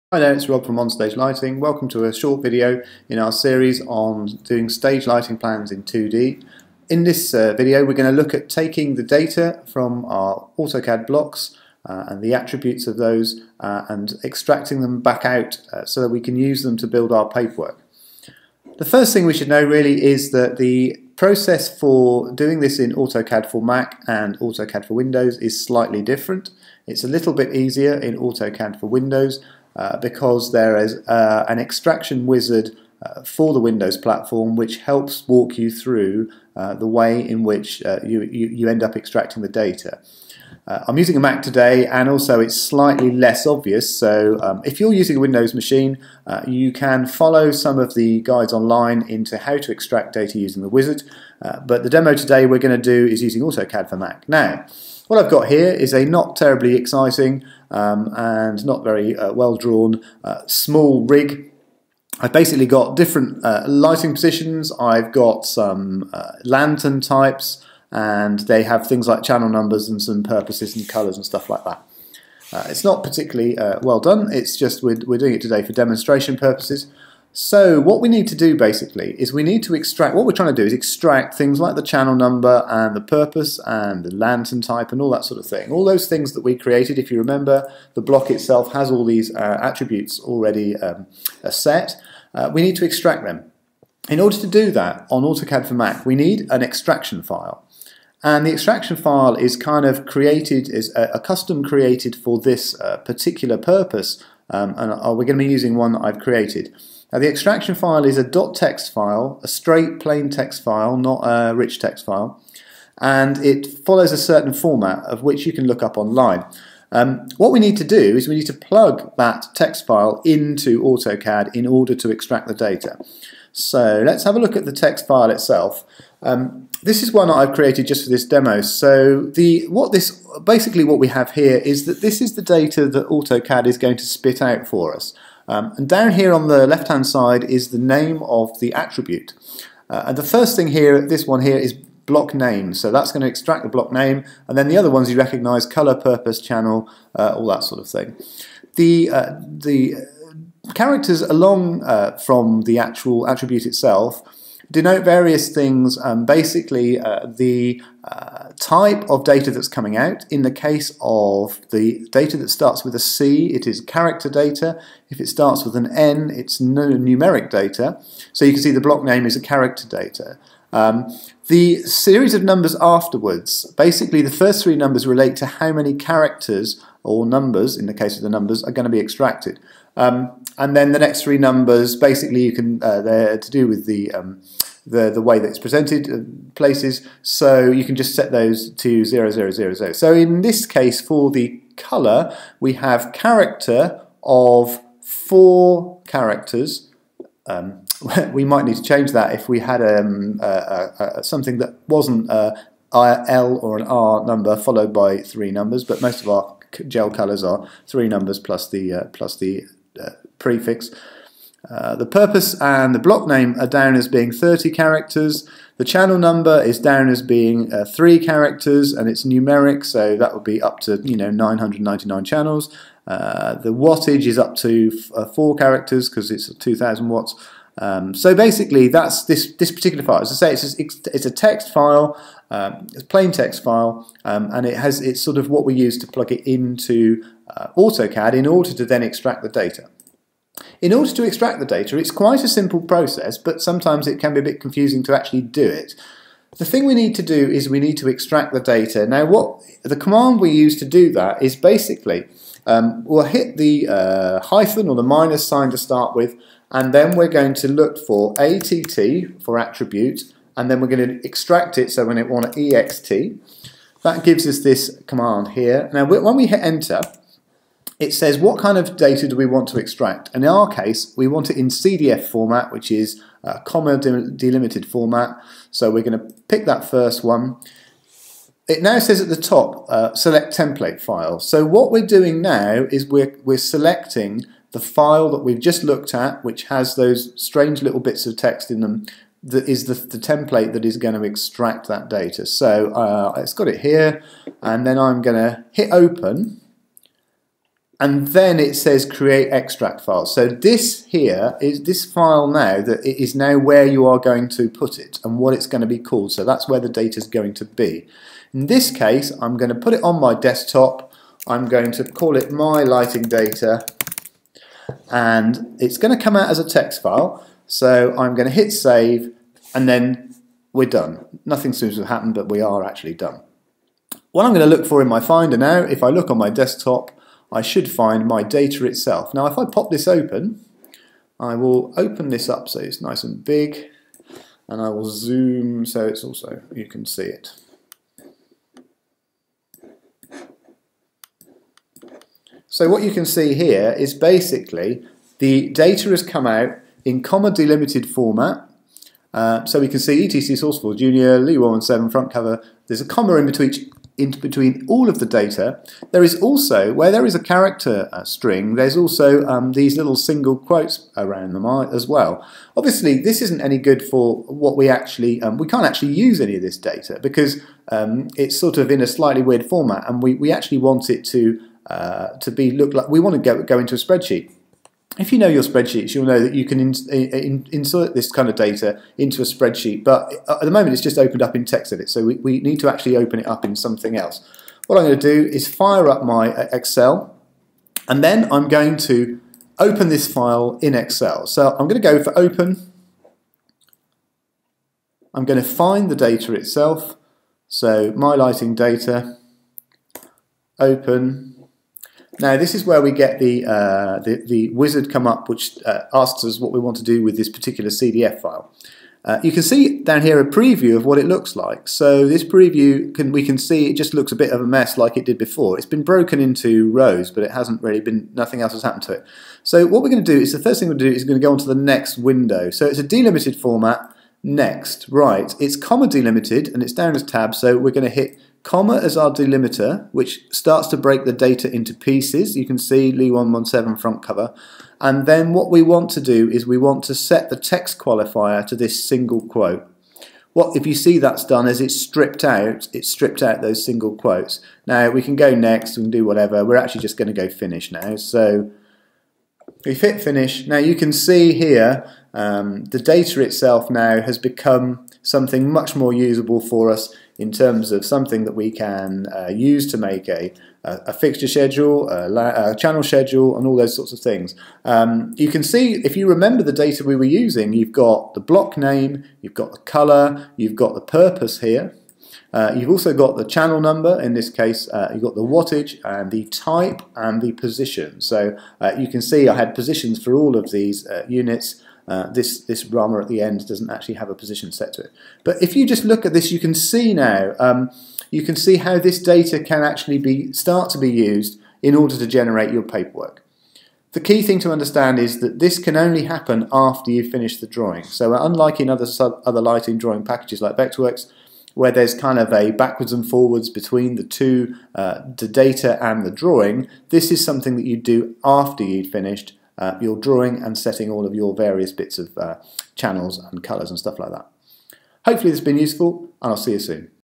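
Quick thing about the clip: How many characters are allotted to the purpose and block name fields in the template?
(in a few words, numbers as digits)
30.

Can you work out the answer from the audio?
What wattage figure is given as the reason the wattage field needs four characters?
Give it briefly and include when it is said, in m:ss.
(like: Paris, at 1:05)
2000 watts, at 3:46.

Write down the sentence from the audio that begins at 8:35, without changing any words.
Hopefully this has been useful and I'll see you soon.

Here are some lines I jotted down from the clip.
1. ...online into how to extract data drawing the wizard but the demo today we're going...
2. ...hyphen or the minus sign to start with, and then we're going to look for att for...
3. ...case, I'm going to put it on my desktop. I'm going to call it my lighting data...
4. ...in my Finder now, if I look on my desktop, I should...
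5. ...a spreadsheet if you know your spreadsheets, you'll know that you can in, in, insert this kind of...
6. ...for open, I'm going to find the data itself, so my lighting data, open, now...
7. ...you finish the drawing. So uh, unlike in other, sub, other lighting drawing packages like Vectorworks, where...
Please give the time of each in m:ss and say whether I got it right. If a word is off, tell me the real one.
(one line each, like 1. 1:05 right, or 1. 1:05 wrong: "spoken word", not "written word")
1. 0:48 wrong: "using", not "drawing"
2. 4:14 right
3. 5:08 right
4. 5:25 right
5. 6:13 right
6. 6:32 right
7. 8:17 right.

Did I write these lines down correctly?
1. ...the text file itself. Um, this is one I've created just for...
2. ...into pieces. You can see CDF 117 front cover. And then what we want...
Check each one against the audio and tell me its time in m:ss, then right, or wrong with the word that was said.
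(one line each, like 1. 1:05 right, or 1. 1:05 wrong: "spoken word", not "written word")
1. 2:04 right
2. 7:11 wrong: "Lee", not "CDF".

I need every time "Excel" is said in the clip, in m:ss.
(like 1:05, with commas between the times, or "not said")
6:26, 6:30.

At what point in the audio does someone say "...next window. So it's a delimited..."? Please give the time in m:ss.
7:01.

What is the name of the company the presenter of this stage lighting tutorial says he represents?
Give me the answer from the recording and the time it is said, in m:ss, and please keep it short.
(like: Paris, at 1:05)
OnStage Lighting, at 0:00.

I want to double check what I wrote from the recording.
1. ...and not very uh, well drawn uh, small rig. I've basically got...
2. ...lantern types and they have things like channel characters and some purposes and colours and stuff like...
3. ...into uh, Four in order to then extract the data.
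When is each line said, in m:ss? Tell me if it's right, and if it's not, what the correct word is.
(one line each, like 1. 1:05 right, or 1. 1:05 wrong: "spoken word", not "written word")
1. 0:58 right
2. 1:06 wrong: "numbers", not "characters"
3. 3:56 wrong: "AutoCAD", not "Four".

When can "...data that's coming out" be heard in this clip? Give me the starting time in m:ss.
2:39.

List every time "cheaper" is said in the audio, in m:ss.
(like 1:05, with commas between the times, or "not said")
not said.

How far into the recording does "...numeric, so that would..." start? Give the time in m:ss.
3:39.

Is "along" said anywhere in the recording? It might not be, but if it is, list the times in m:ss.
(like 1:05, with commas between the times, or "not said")
2:31.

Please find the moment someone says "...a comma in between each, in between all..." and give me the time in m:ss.
5:53.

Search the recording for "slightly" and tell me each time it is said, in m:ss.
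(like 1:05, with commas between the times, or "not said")
0:25, 0:42, 6:09.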